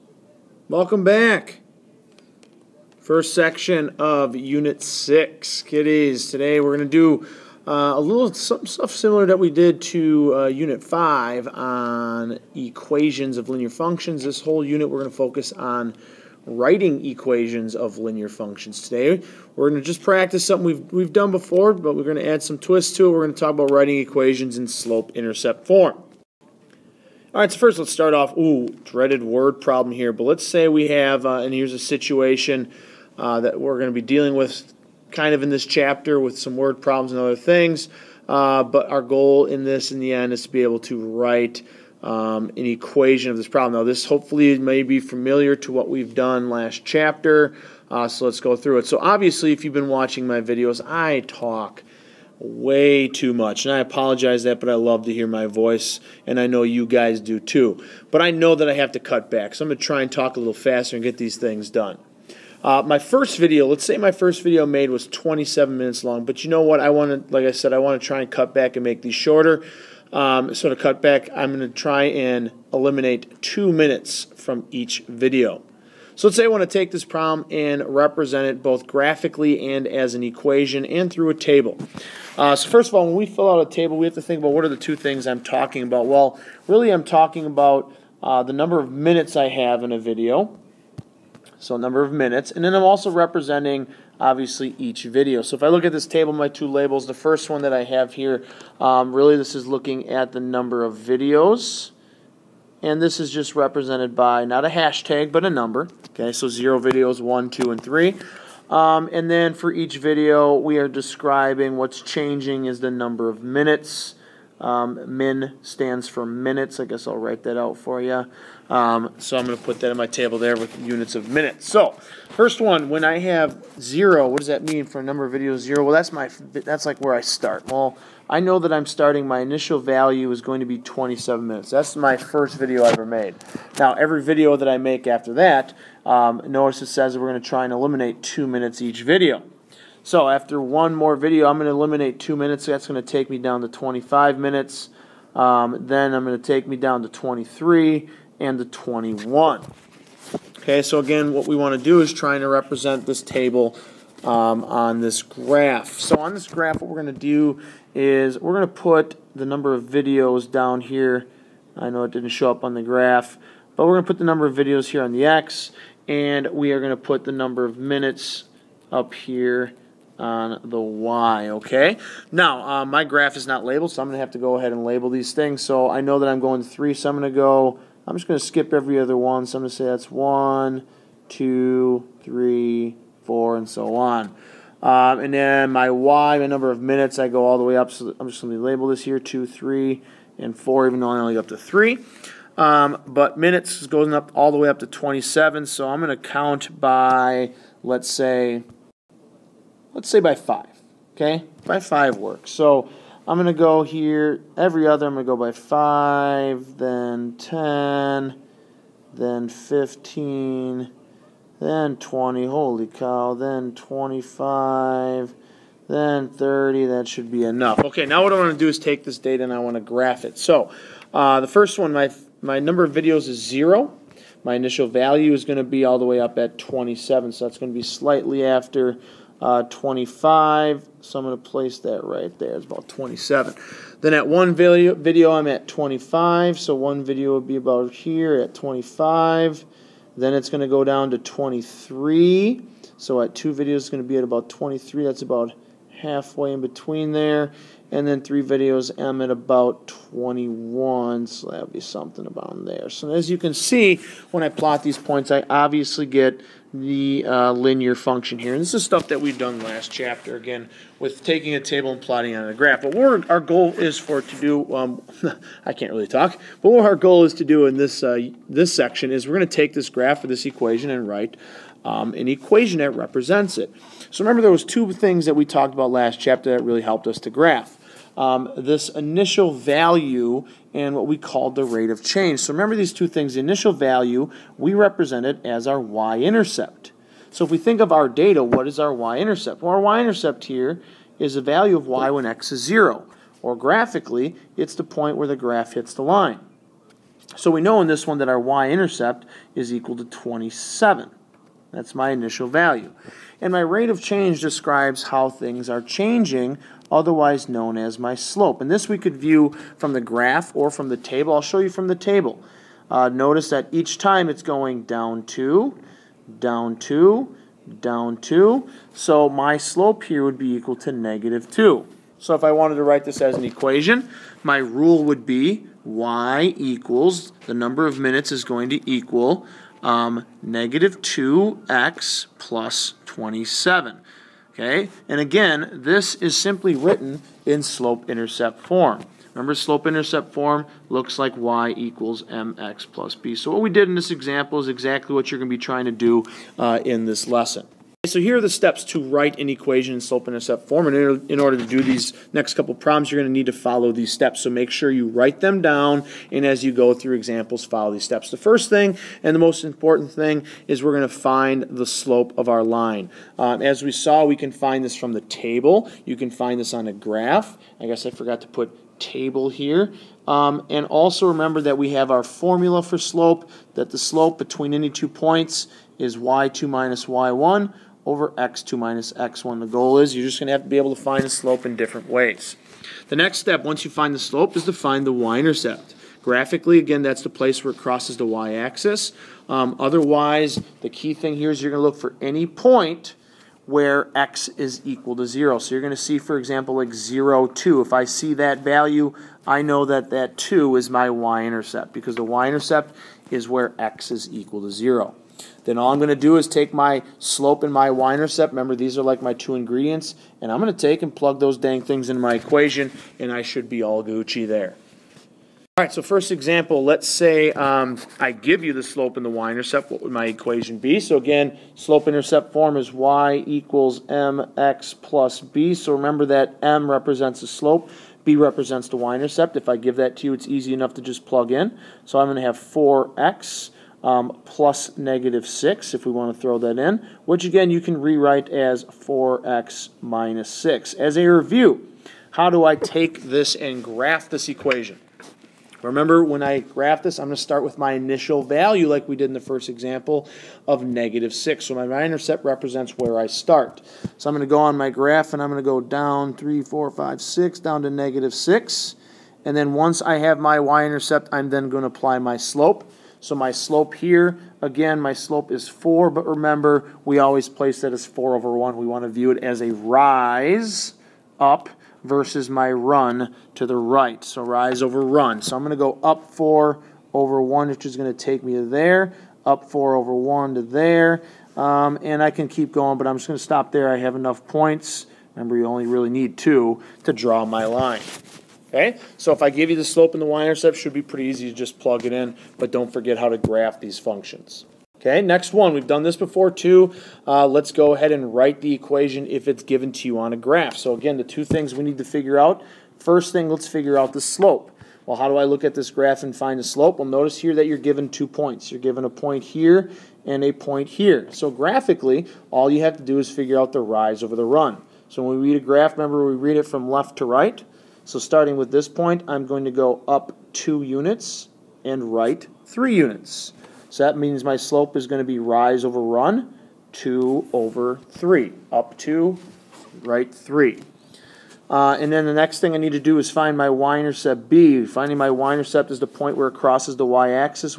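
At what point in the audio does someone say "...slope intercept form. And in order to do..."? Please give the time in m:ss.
5:50.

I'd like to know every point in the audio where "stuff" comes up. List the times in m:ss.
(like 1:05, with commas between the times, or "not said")
0:08, 4:18.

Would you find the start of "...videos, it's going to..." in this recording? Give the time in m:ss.
4:03.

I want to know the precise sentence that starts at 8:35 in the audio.
So when we read a graph, remember we read it from left to right.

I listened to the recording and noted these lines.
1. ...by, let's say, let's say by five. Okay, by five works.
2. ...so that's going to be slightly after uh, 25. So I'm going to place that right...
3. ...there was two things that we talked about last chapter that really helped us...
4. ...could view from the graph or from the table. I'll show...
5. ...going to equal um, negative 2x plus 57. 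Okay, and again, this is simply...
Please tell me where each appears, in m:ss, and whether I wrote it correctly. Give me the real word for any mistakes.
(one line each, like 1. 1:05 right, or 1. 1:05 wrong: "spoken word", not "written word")
1. 3:16 right
2. 3:47 right
3. 4:34 right
4. 5:08 right
5. 5:28 wrong: "27", not "57".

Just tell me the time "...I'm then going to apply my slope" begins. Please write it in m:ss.
7:41.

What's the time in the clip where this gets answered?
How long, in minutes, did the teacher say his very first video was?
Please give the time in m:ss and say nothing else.
1:05.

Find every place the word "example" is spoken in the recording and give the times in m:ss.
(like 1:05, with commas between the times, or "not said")
5:44, 5:57, 6:36, 6:56, 7:29.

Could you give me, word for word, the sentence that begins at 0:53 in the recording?
And I apologize that, but I love to hear my voice, and I know you guys do too.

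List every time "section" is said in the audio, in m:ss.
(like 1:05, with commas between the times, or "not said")
0:03, 4:28.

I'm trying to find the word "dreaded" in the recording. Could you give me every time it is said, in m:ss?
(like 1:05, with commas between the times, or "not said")
0:28.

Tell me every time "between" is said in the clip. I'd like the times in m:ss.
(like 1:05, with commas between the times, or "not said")
4:06, 6:14.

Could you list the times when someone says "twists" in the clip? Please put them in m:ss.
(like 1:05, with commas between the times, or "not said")
0:22.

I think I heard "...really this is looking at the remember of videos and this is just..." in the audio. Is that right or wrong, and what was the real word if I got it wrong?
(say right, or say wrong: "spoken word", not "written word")
wrong: "number", not "remember".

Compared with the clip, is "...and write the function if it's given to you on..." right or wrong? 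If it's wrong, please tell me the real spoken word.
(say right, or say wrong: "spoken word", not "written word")
wrong: "equation", not "function".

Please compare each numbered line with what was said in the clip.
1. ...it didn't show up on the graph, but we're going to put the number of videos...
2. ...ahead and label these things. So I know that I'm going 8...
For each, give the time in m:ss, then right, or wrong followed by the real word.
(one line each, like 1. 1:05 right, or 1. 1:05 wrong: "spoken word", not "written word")
1. 2:42 right
2. 2:54 wrong: "3", not "8".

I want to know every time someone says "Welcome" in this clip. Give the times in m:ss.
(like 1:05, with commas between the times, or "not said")
0:00.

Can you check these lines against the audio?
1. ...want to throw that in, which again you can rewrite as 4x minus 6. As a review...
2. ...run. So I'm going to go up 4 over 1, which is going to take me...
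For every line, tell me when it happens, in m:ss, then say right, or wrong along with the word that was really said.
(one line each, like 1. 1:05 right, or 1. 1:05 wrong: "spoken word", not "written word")
1. 7:16 right
2. 7:55 right.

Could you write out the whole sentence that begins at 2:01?
So first one, when I have zero, what does that mean for a number of videos?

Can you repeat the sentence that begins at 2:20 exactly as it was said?
So after one more video, I'm going to eliminate two minutes.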